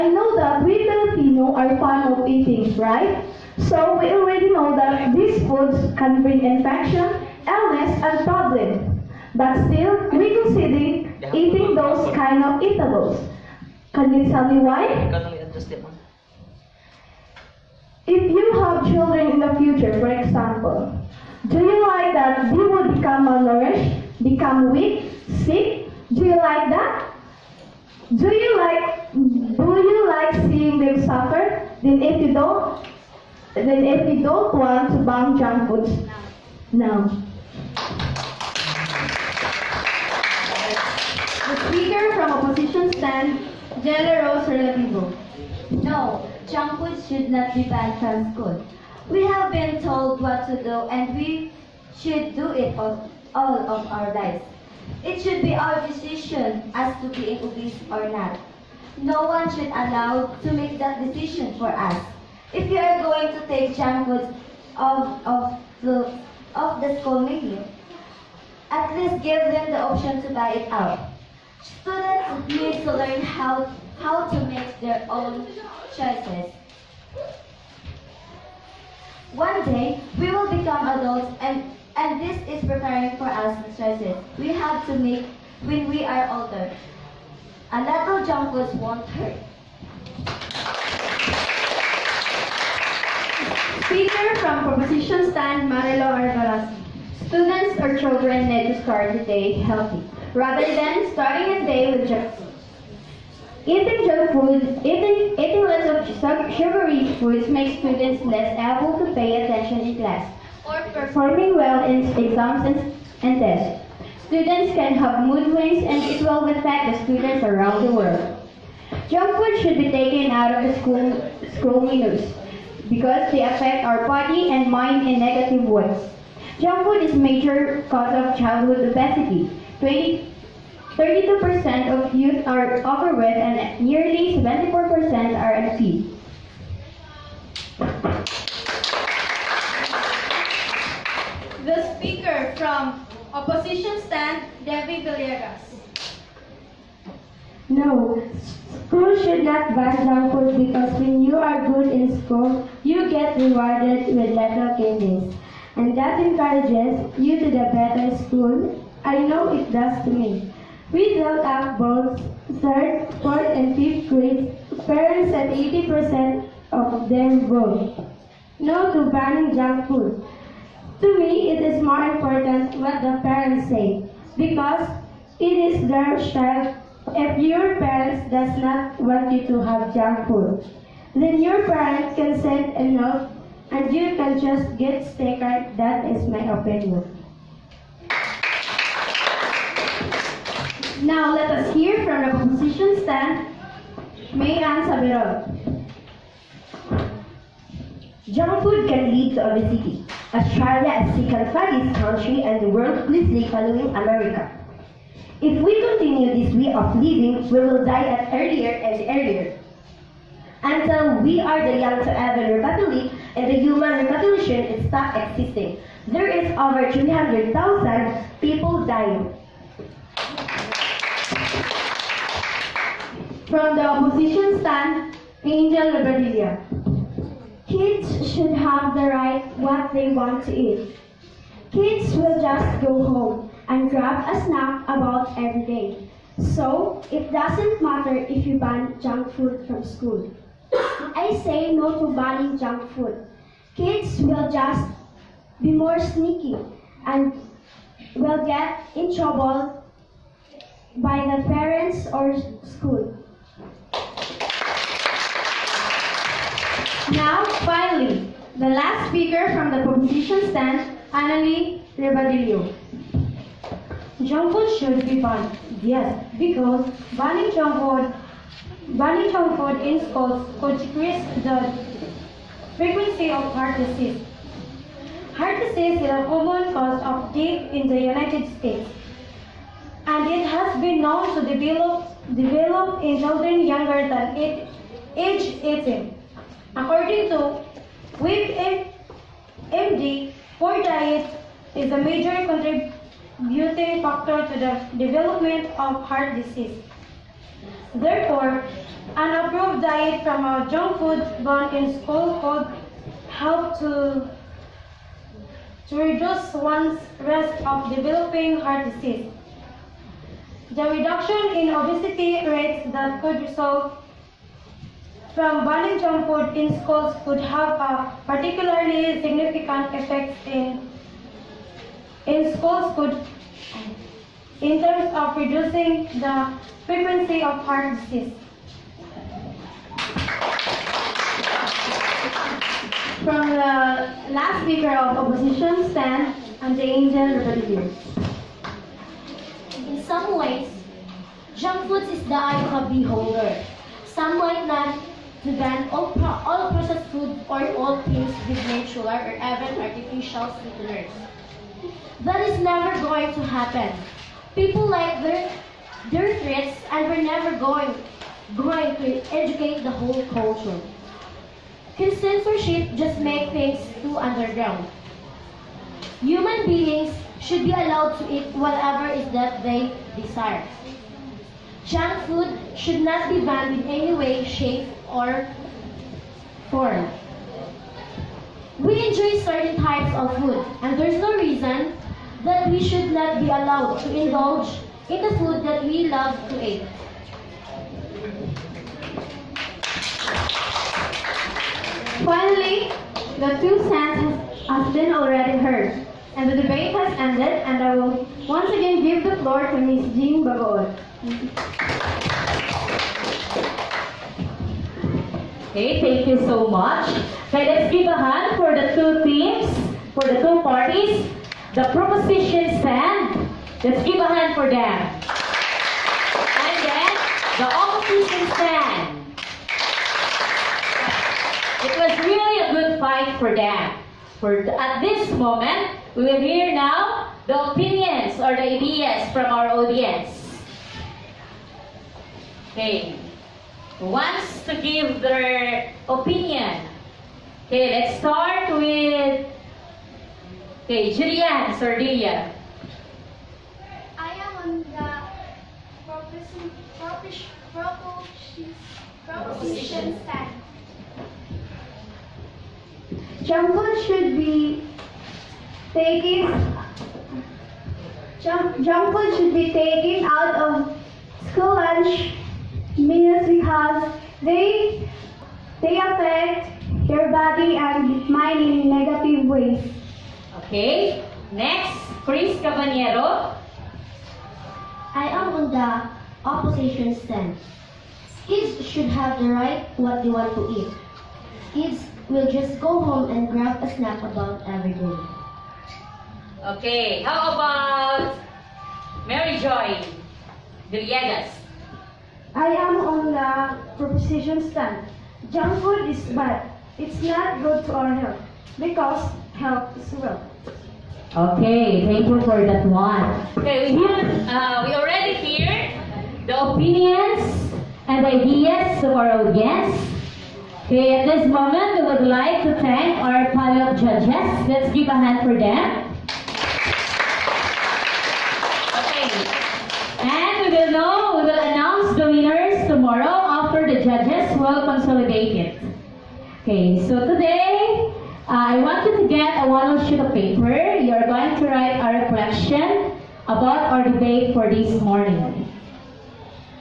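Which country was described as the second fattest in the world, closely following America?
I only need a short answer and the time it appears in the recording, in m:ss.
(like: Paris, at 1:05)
Australia, at 3:20.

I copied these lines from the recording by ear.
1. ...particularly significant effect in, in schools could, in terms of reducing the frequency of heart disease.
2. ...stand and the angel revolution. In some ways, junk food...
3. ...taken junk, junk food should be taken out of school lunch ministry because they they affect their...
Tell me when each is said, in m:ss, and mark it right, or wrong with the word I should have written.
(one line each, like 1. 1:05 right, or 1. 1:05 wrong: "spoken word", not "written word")
1. 5:18 right
2. 5:35 wrong: "rebellion", not "revolution"
3. 7:35 right.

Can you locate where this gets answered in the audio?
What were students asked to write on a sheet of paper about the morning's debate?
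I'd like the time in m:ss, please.
8:52.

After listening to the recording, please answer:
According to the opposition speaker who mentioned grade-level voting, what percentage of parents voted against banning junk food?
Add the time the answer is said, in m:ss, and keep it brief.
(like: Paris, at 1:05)
80%, at 2:45.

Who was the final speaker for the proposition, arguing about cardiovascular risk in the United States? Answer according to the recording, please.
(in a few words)
Annalie Ribadillo.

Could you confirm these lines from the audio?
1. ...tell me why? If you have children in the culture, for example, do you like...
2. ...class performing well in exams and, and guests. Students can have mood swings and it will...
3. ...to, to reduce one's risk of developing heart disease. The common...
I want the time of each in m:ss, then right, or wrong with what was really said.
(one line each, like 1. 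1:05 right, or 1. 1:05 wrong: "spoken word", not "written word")
1. 0:14 wrong: "future", not "culture"
2. 1:49 wrong: "tests", not "guests"
3. 5:03 wrong: "reduction", not "common".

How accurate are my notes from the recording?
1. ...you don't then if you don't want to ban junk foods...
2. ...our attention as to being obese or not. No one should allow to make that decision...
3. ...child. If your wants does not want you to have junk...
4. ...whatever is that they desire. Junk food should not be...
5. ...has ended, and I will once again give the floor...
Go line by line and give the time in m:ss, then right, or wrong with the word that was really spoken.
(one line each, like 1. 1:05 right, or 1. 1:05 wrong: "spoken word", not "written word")
1. 0:32 right
2. 0:55 wrong: "decision", not "attention"
3. 2:56 wrong: "parents", not "wants"
4. 6:08 right
5. 6:36 right.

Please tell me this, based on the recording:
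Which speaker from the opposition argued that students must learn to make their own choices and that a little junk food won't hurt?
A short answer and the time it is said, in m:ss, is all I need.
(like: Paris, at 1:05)
Jella Rose Relativo, at 0:43.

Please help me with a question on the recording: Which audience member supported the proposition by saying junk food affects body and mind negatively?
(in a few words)
Julian Sardilla.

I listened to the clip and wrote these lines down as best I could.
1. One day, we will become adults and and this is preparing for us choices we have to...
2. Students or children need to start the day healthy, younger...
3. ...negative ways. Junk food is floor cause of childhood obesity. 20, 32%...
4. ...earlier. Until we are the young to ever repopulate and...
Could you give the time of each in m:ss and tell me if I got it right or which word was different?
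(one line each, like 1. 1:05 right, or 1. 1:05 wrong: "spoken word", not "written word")
1. 1:19 right
2. 1:37 wrong: "rather", not "younger"
3. 2:05 wrong: "major", not "floor"
4. 3:29 right.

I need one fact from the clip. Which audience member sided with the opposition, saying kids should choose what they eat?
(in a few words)
Chris Cabanero.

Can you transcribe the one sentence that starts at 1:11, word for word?
Students need to learn how, how to make their own choices.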